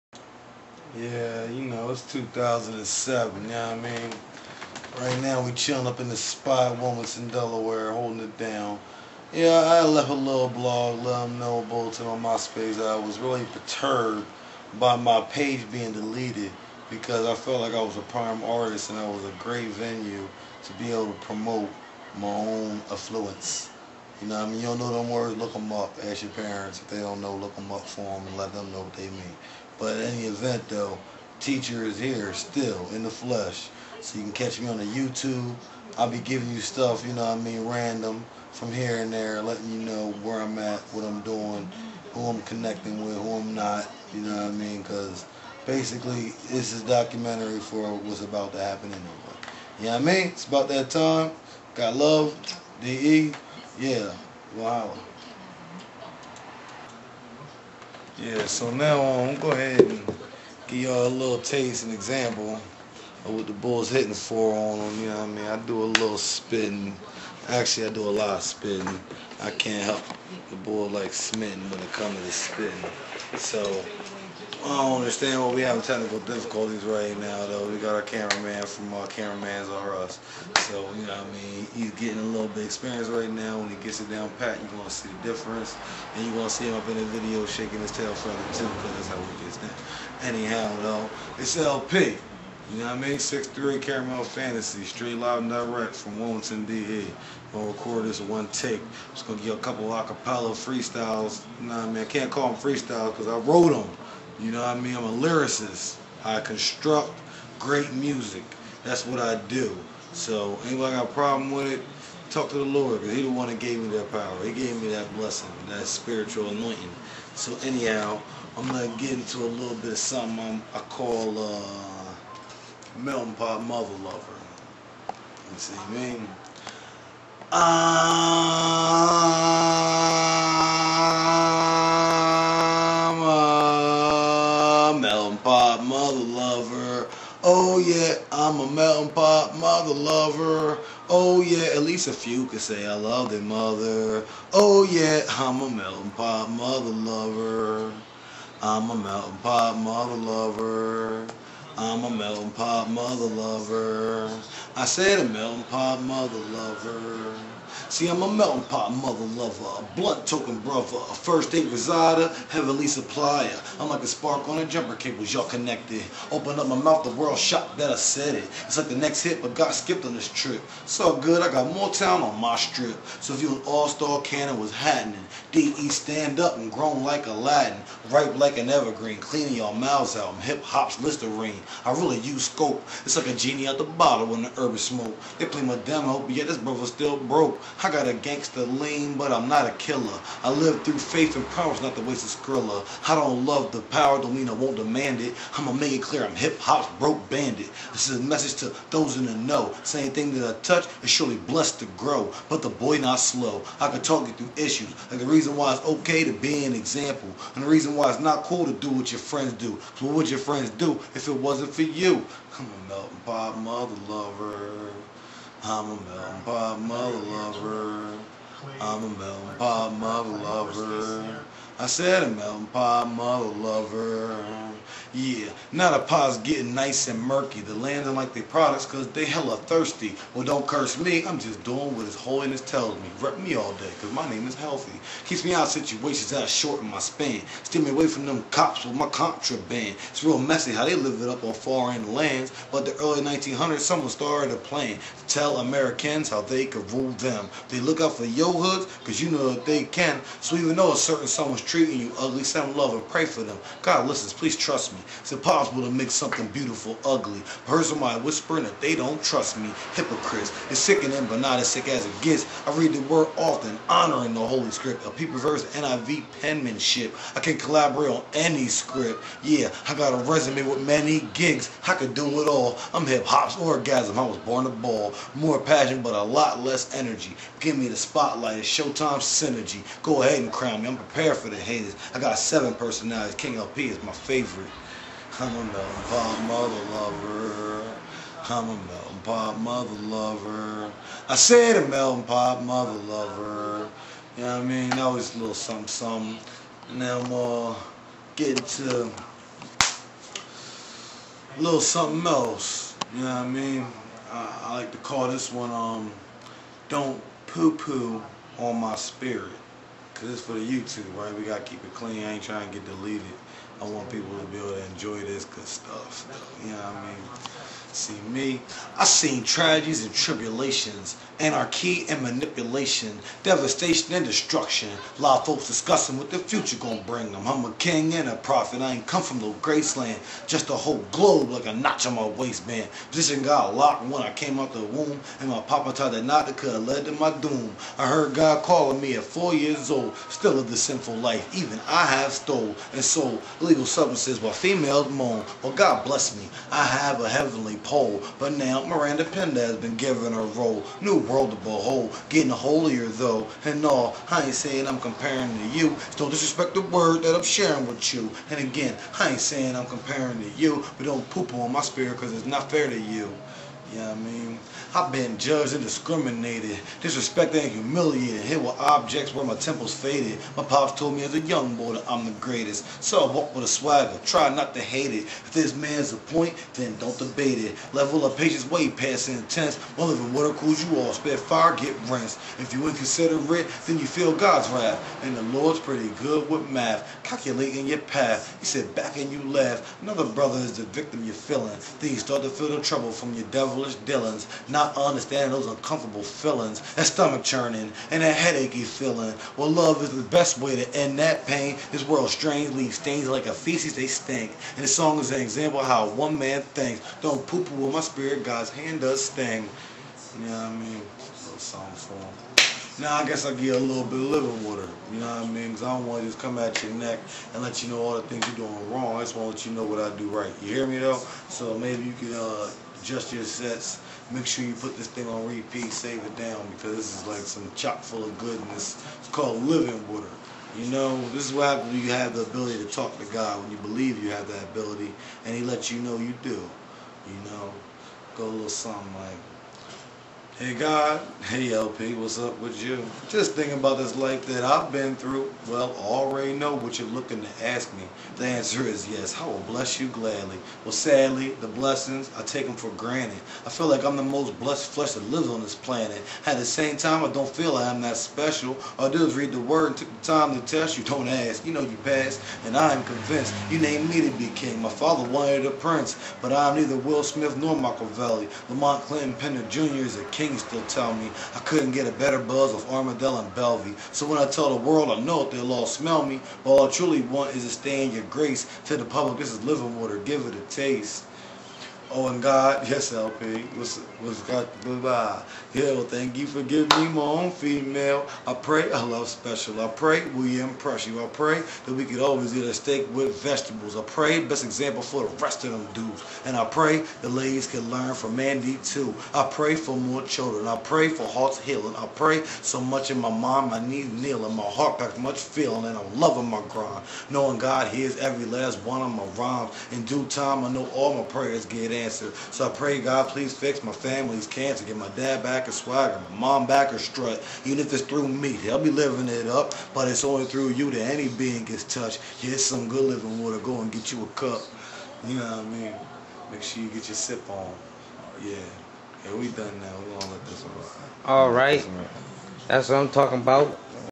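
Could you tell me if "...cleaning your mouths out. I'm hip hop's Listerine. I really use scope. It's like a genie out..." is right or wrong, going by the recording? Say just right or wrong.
right.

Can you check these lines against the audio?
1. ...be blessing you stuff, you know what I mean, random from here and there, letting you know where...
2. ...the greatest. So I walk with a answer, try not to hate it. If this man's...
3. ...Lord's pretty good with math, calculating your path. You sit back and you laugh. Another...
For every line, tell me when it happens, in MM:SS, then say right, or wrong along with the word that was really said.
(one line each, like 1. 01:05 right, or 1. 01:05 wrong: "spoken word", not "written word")
1. 00:36 wrong: "giving", not "blessing"
2. 06:12 wrong: "swagger", not "answer"
3. 06:25 right.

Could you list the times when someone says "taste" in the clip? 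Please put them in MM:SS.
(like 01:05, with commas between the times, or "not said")
01:01, 08:00.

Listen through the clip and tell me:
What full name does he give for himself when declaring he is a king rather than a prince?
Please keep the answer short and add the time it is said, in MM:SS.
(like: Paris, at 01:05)
Lamont Clinton Pender Jr., at 07:48.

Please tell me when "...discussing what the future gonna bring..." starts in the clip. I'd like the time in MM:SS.
05:25.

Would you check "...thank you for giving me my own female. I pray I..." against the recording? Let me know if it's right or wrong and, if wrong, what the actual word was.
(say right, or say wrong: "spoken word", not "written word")
right.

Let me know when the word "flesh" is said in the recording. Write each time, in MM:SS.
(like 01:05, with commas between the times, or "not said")
00:33, 07:34.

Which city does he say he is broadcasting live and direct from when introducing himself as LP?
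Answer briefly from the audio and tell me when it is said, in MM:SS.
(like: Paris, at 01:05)
Wilmington, at 01:36.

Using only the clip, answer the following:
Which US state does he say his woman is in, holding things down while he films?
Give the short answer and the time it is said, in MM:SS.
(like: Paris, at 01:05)
Delaware, at 00:07.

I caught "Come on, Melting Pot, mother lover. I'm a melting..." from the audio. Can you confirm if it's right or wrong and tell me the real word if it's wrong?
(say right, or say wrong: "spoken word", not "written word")
right.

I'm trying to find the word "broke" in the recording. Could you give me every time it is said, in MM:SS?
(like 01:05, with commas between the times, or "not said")
03:07, 03:16.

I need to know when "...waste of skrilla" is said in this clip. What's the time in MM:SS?
03:12.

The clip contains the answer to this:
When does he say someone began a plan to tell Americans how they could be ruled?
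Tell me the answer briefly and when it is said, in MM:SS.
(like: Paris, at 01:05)
Early 1900s, at 04:02.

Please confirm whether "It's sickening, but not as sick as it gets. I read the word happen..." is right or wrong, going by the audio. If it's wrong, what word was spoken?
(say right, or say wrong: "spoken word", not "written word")
wrong: "often", not "happen".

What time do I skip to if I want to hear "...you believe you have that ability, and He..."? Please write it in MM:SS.
07:13.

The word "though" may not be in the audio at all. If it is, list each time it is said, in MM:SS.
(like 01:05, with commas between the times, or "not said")
00:30, 01:17, 01:30, 04:10, 05:53, 07:00.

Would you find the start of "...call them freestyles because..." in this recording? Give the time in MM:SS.
01:42.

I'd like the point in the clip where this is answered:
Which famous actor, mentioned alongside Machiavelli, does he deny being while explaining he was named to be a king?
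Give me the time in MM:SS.
07:46.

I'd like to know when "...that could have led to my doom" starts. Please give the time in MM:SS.
05:36.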